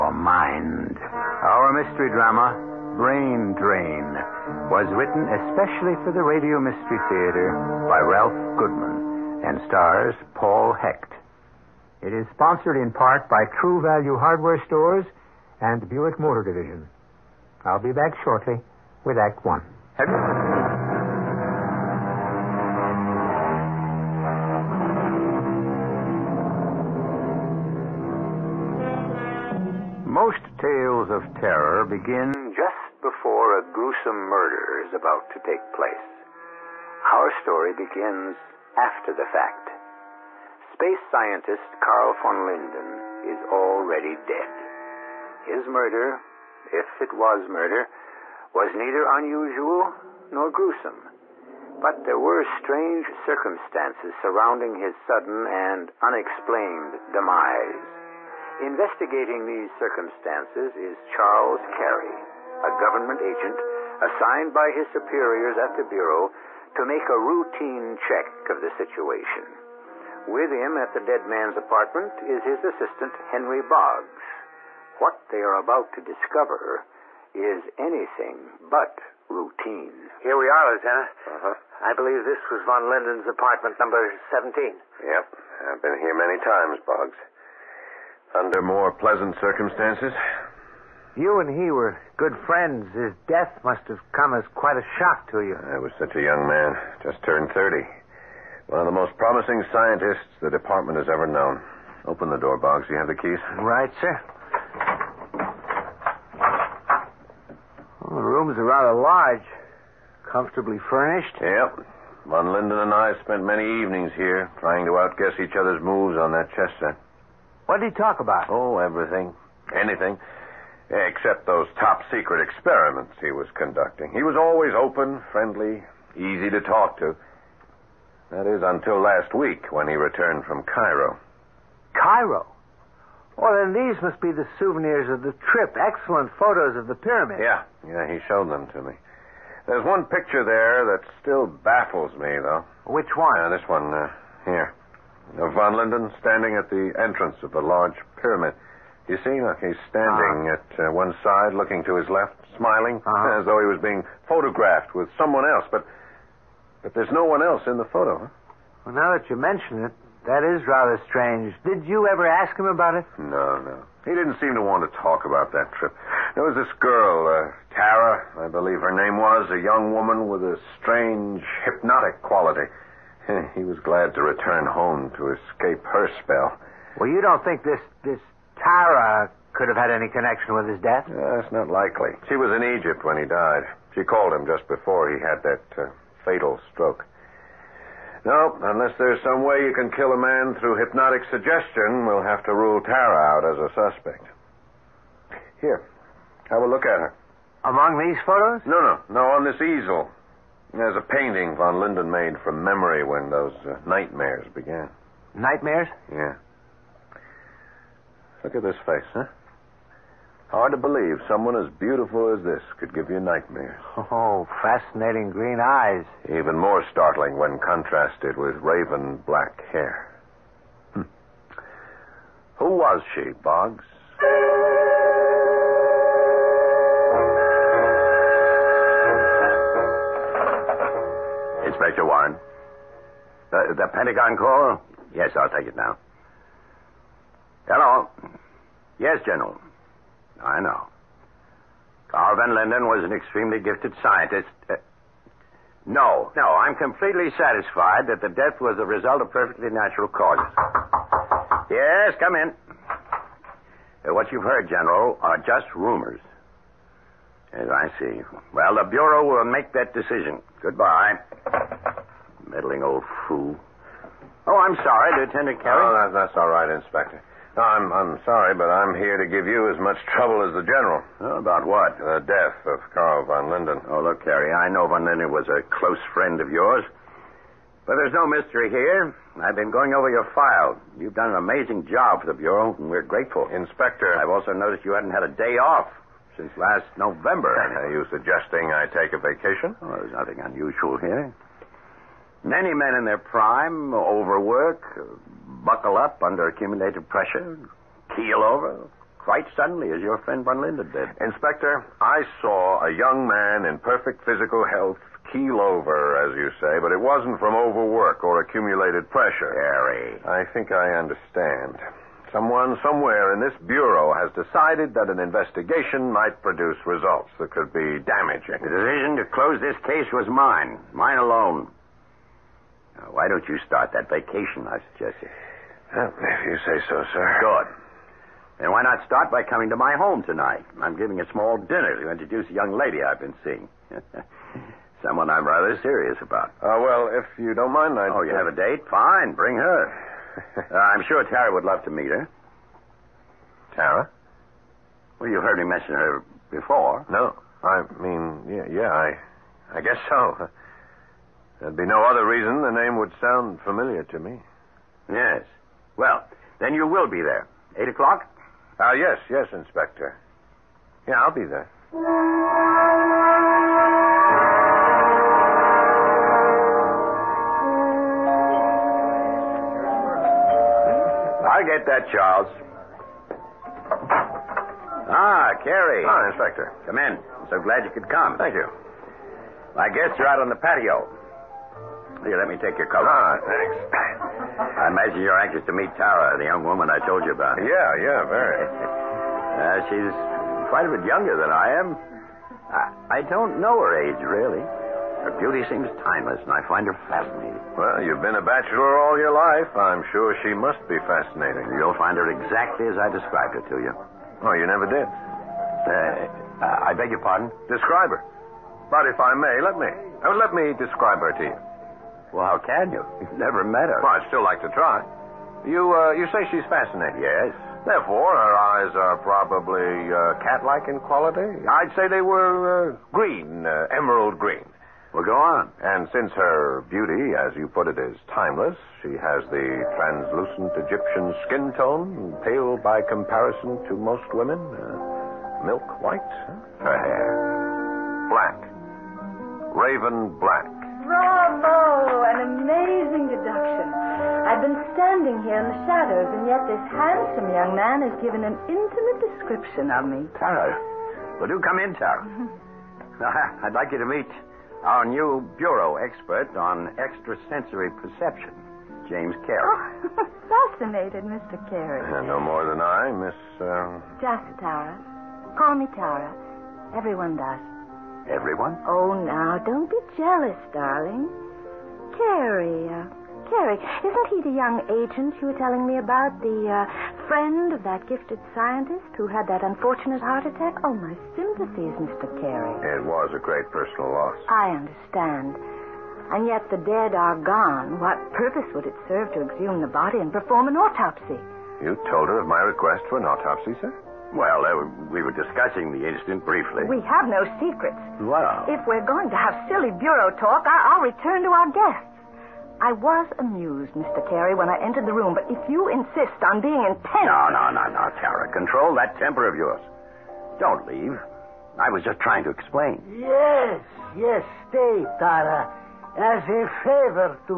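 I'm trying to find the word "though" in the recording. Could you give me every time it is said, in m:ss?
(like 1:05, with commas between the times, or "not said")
2:22, 2:33.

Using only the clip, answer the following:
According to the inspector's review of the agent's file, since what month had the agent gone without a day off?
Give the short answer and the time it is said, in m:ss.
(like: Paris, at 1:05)
November, at 4:47.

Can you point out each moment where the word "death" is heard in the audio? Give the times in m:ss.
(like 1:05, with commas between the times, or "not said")
1:33, 3:00, 4:08, 4:32.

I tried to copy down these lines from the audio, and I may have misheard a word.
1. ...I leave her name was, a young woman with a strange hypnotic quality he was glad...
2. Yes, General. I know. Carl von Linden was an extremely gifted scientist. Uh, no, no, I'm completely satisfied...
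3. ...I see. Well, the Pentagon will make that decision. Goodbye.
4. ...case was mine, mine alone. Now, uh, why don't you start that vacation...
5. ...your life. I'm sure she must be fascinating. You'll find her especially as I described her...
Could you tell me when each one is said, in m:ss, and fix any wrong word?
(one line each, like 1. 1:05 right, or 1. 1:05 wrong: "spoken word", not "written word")
1. 2:48 wrong: "believe", not "leave"
2. 3:58 right
3. 4:17 wrong: "Bureau", not "Pentagon"
4. 5:19 right
5. 6:39 wrong: "exactly", not "especially".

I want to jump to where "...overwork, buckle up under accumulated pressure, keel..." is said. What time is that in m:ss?
4:53.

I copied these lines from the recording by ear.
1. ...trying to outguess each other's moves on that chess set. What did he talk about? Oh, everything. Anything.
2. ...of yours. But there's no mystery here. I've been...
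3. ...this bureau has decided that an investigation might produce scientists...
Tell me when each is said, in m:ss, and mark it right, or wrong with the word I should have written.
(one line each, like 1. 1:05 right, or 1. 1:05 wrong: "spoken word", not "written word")
1. 1:54 right
2. 4:36 right
3. 5:13 wrong: "results", not "scientists".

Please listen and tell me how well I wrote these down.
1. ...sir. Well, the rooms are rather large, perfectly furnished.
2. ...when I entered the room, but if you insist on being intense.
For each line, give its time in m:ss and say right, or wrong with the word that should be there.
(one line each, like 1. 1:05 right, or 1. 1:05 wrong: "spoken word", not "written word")
1. 1:44 wrong: "comfortably", not "perfectly"
2. 8:24 right.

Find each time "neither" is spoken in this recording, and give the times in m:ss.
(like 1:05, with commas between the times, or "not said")
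0:48.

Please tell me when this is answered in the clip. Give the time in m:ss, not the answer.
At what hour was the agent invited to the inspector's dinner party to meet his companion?
5:57.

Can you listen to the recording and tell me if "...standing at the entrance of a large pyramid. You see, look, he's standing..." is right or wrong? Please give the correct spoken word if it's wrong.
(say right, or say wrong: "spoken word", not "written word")
right.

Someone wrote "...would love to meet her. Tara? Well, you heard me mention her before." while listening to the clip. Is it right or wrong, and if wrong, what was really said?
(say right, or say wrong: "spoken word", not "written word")
right.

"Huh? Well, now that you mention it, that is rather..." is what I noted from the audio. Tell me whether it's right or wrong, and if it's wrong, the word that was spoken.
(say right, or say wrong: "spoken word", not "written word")
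right.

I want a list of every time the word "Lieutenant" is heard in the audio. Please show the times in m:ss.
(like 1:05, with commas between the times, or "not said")
1:20, 4:25.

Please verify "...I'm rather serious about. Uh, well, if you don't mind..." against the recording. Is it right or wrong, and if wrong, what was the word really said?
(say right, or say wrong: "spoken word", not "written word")
right.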